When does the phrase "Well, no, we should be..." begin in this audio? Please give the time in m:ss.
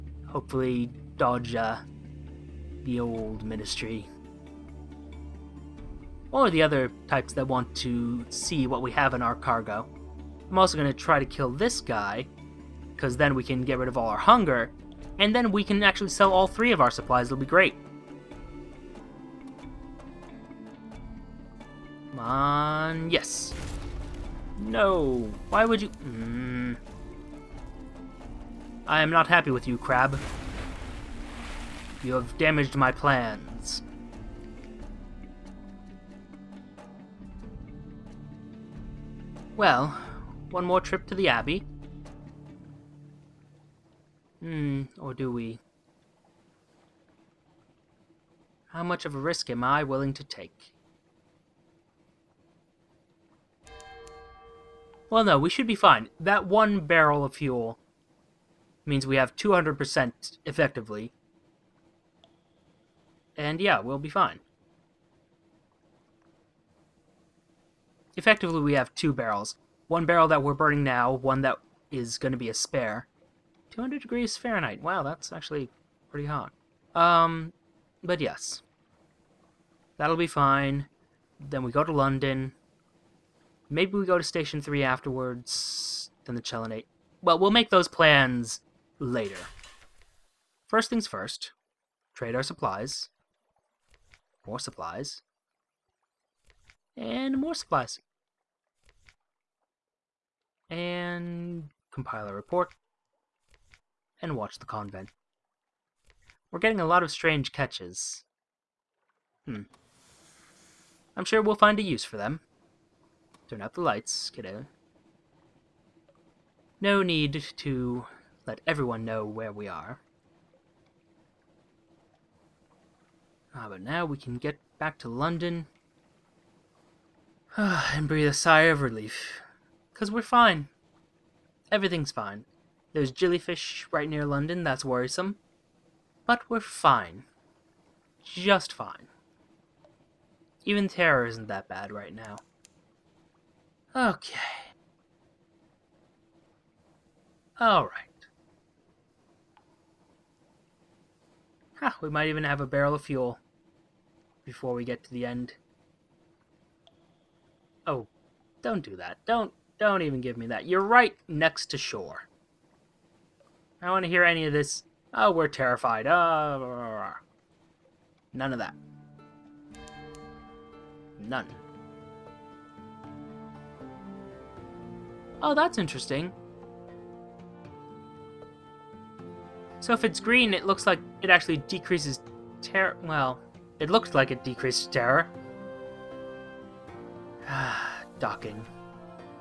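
0:55.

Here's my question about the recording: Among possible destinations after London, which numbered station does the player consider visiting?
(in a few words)
Station 3.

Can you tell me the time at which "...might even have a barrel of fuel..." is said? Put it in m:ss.
2:32.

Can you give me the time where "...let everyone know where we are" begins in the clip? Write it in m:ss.
1:58.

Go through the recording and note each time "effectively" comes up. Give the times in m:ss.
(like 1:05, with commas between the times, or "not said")
1:00, 1:08.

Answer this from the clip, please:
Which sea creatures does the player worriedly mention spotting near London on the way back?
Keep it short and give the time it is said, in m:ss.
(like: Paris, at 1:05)
Jellyfish, at 2:13.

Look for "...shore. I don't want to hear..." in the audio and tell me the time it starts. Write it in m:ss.
2:41.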